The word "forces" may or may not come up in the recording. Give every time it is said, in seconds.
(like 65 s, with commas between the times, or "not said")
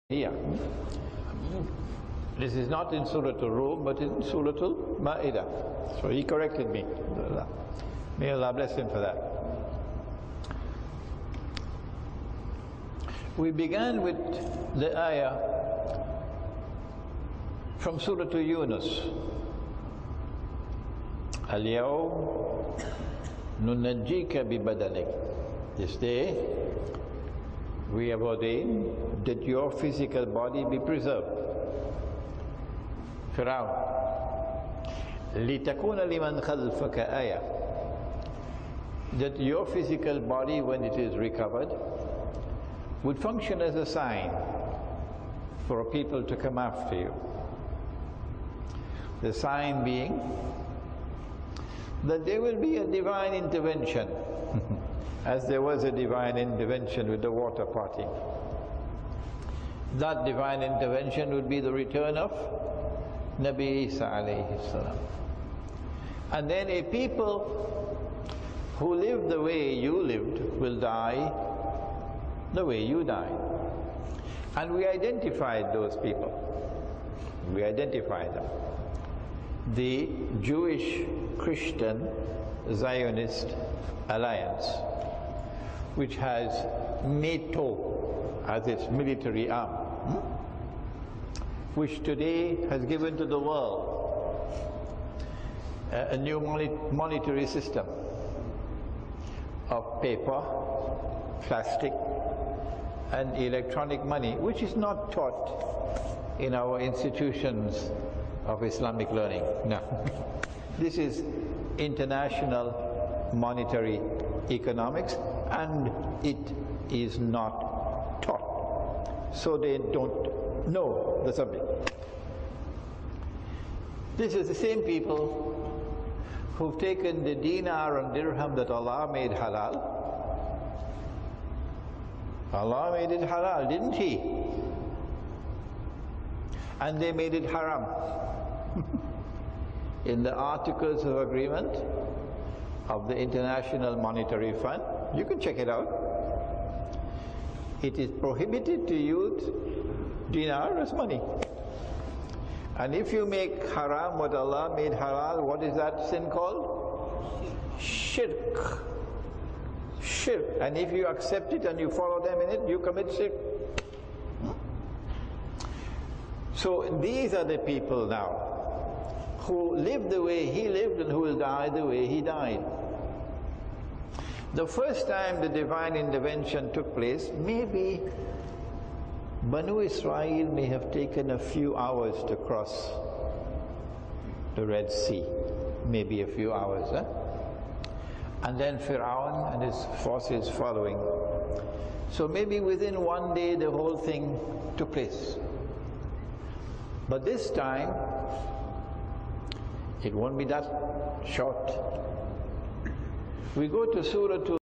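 190 s.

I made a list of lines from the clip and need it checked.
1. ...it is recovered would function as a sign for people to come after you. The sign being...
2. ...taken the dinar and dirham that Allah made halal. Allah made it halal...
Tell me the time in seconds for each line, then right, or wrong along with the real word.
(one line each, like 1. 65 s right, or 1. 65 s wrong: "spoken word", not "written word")
1. 40 s right
2. 126 s right.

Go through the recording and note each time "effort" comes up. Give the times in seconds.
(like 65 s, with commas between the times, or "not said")
not said.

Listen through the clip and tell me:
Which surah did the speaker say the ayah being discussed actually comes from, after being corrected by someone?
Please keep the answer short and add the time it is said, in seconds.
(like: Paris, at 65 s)
Surah Al-Ma'idah, at 4 s.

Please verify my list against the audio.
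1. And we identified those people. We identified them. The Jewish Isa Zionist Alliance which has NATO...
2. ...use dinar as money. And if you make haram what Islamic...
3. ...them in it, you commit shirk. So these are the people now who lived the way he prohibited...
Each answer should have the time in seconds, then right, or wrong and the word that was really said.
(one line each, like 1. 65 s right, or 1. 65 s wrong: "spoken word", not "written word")
1. 74 s wrong: "Christian", not "Isa"
2. 148 s wrong: "Allah", not "Islamic"
3. 162 s wrong: "lived", not "prohibited".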